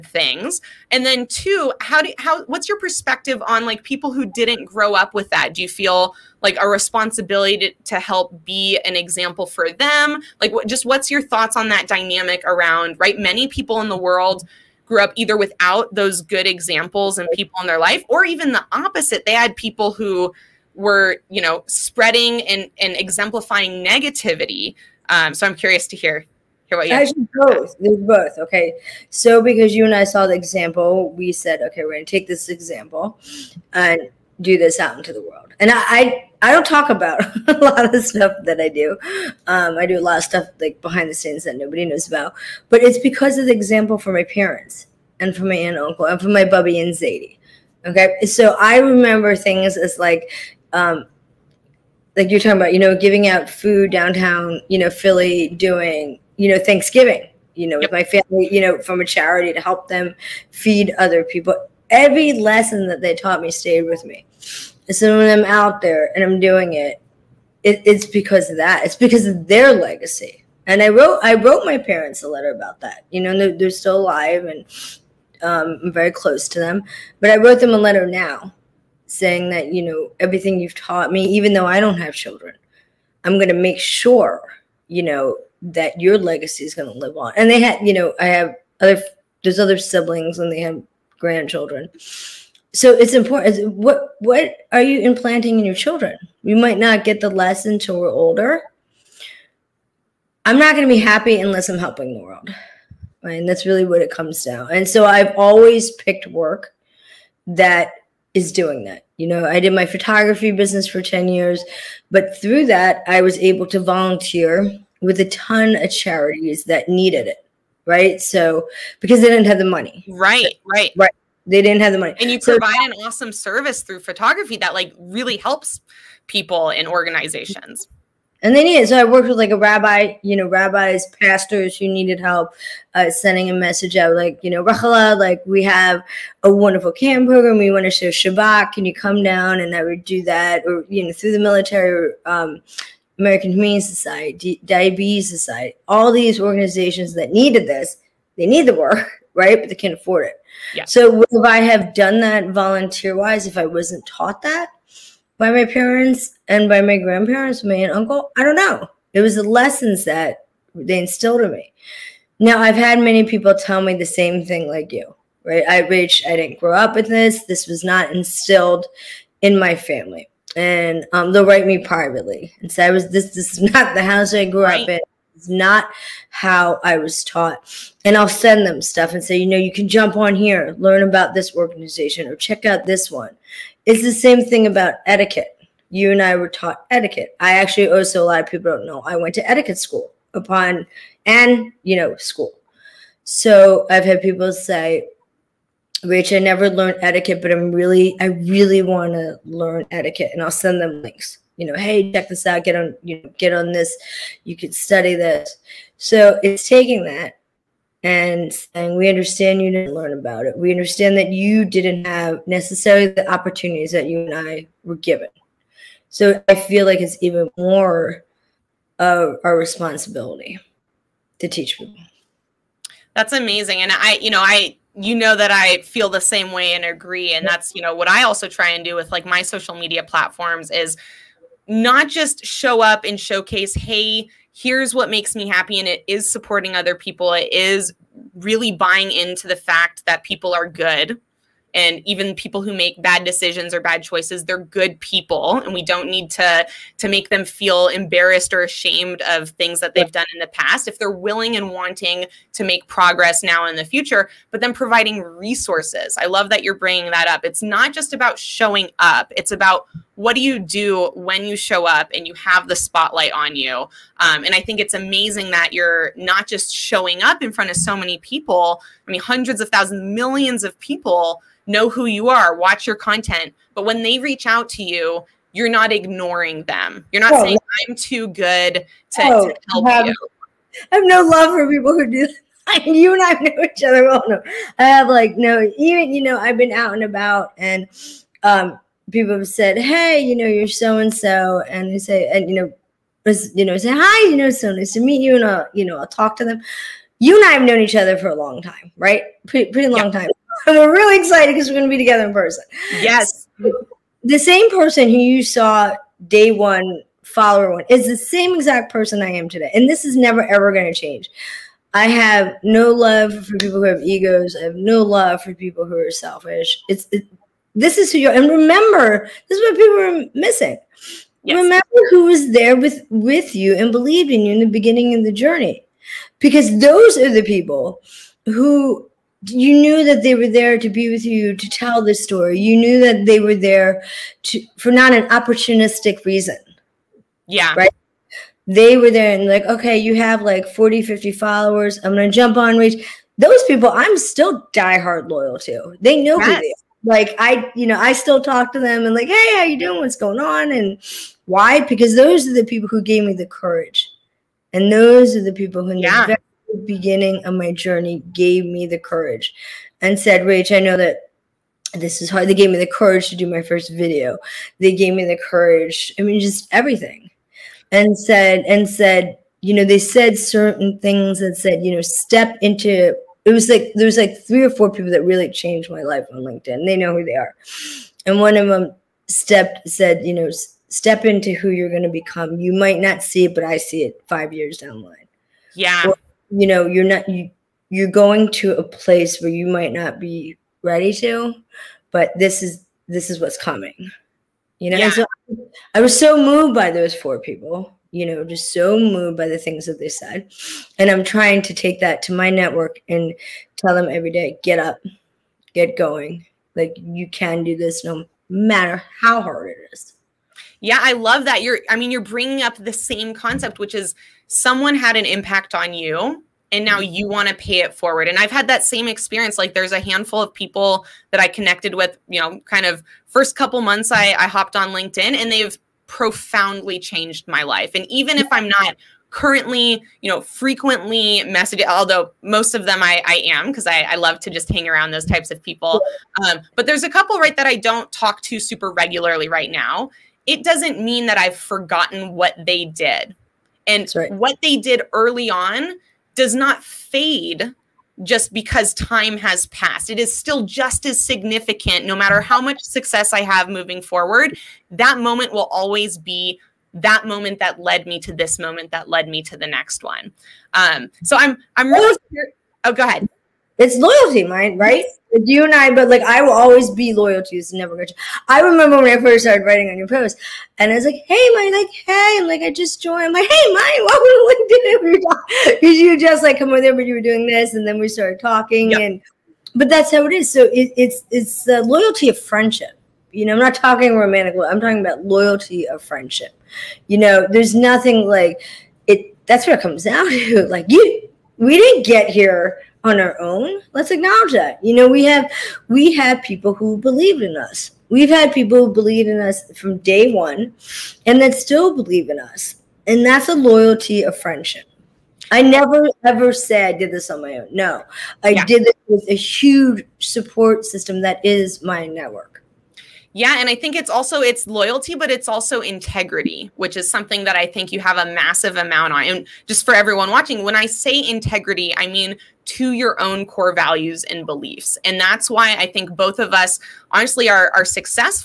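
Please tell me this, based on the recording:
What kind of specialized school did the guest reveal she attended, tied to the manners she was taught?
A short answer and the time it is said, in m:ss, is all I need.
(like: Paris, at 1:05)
etiquette school, at 3:09.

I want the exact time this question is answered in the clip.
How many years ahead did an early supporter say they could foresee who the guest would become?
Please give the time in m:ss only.
6:24.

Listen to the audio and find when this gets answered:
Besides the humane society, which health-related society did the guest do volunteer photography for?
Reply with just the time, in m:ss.
2:24.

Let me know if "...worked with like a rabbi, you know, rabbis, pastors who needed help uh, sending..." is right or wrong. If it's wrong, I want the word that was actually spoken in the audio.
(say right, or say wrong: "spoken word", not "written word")
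right.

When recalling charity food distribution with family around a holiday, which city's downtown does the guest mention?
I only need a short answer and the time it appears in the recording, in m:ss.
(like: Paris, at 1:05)
Philly, at 0:54.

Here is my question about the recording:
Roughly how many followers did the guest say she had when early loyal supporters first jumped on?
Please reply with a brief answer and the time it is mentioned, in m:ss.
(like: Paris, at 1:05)
40, 50, at 5:40.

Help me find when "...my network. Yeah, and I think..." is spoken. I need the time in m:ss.
8:31.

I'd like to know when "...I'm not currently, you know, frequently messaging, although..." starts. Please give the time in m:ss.
7:08.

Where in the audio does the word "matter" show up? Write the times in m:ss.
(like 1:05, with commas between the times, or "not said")
6:48, 7:32.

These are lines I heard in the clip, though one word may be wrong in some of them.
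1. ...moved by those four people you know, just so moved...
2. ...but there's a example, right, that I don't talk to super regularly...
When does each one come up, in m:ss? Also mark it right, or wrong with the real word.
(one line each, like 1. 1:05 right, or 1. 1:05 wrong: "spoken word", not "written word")
1. 6:36 right
2. 7:16 wrong: "couple", not "example".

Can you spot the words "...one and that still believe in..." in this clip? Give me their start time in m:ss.
8:20.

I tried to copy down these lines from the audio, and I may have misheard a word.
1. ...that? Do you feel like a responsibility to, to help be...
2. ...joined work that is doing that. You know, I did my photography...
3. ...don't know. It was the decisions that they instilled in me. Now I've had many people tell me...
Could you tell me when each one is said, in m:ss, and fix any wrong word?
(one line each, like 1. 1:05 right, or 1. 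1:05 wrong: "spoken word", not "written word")
1. 0:05 right
2. 1:45 wrong: "picked", not "joined"
3. 2:38 wrong: "lessons", not "decisions".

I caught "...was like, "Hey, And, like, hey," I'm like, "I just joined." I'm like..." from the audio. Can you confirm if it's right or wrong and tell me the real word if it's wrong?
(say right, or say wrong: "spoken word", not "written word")
wrong: "Maayan", not "And".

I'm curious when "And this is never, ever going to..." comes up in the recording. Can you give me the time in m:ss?
5:09.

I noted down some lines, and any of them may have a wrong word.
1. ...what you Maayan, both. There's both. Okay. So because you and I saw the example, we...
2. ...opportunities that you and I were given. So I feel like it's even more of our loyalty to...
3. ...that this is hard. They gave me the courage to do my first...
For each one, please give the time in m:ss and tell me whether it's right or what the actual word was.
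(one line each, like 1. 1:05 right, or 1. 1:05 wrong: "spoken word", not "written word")
1. 0:26 wrong: "Actually", not "Maayan"
2. 3:33 wrong: "responsibility", not "loyalty"
3. 6:00 right.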